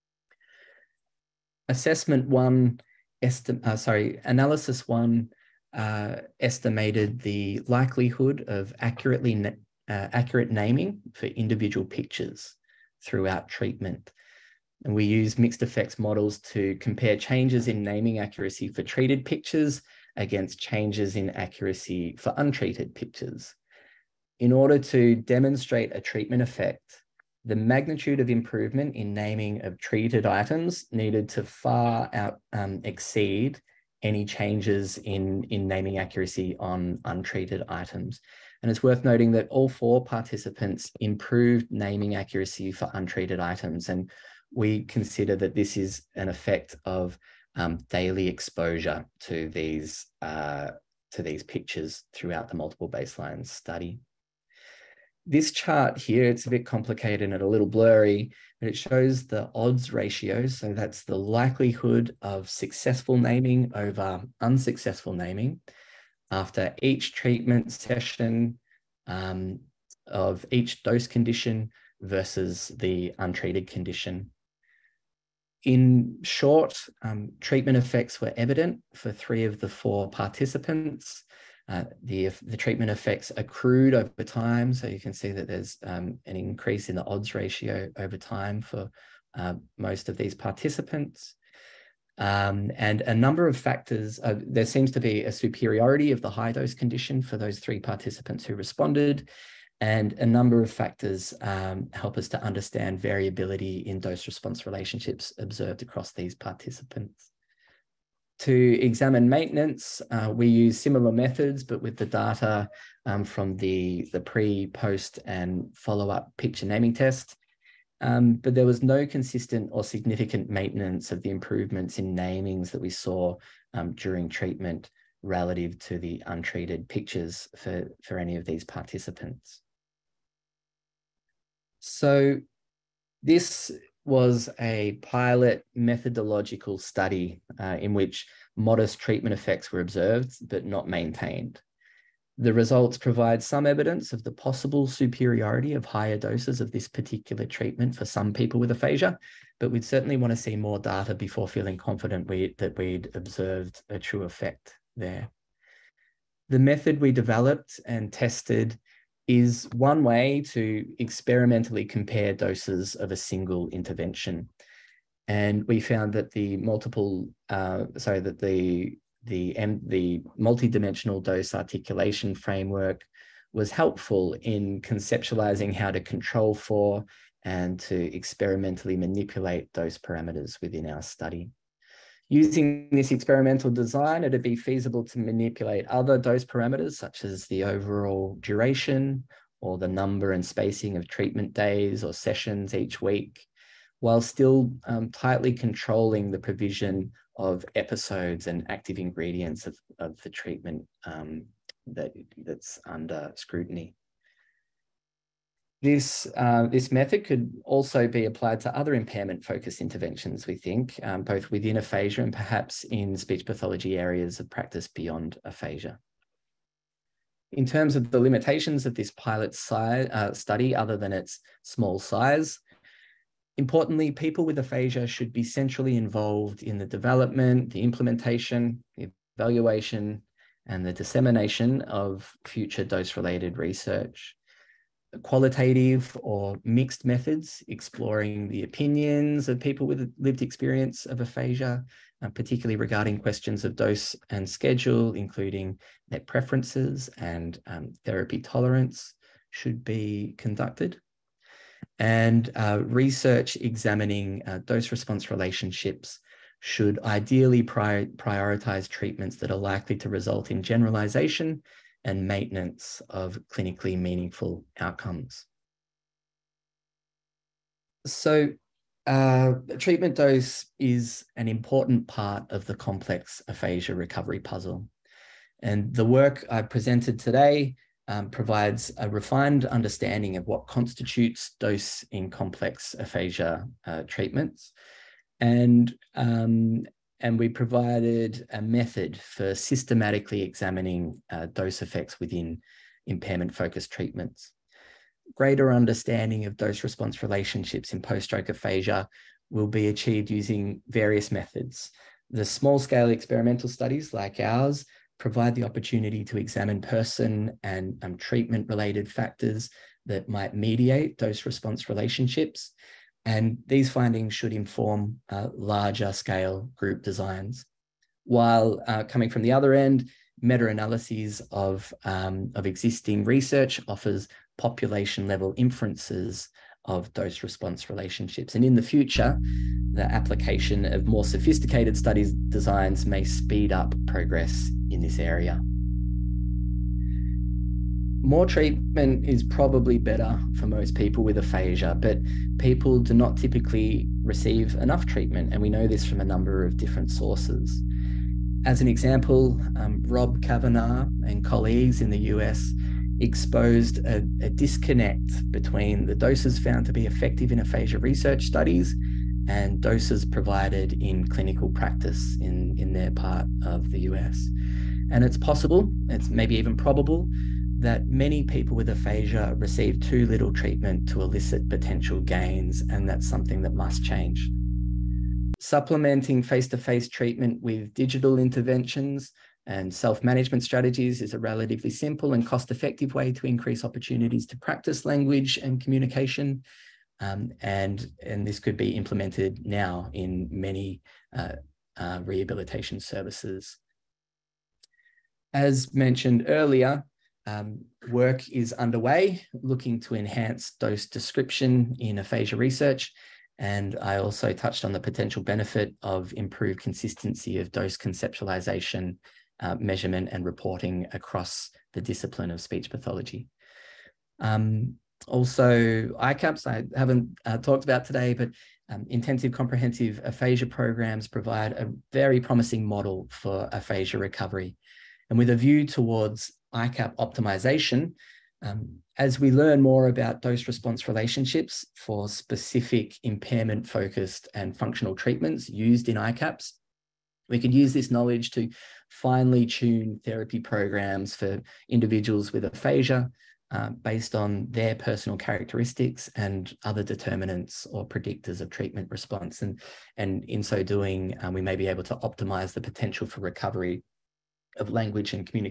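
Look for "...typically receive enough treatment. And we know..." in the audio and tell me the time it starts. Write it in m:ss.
5:43.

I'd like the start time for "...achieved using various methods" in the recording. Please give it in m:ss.
4:59.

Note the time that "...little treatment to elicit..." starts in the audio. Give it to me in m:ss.
6:10.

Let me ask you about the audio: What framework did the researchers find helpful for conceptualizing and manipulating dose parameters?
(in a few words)
multidimensional dose articulation framework.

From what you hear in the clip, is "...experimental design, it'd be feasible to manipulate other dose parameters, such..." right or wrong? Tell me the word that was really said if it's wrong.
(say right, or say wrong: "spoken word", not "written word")
right.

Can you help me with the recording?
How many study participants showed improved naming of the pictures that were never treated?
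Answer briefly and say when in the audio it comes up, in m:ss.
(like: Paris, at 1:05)
4, at 0:39.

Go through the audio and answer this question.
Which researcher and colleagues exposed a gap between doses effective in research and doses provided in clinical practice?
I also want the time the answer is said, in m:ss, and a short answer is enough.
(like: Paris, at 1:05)
Rob Cavanaugh, at 5:50.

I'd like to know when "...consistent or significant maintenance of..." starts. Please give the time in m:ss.
1:59.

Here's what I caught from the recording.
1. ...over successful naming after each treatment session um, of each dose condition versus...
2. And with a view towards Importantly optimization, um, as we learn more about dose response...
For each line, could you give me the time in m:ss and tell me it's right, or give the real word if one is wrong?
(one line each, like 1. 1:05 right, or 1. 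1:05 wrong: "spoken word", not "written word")
1. 1:03 wrong: "unsuccessful", not "successful"
2. 7:05 wrong: "ICAP", not "Importantly".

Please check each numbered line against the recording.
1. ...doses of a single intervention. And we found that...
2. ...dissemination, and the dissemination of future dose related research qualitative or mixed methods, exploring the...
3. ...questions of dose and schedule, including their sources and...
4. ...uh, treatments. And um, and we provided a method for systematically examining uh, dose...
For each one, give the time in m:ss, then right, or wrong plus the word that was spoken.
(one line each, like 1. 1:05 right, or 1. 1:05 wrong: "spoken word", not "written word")
1. 2:42 right
2. 3:49 wrong: "evaluation", not "dissemination"
3. 4:03 wrong: "preferences", not "sources"
4. 4:43 right.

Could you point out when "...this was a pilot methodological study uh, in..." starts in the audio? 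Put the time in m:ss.
2:13.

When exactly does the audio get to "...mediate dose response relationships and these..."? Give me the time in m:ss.
5:10.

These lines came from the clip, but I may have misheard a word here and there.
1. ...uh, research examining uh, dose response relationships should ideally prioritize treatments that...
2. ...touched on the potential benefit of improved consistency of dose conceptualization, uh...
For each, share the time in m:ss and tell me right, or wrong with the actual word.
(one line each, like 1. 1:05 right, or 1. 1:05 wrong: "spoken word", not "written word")
1. 4:12 right
2. 6:44 right.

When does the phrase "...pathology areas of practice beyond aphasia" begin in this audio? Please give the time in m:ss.
3:33.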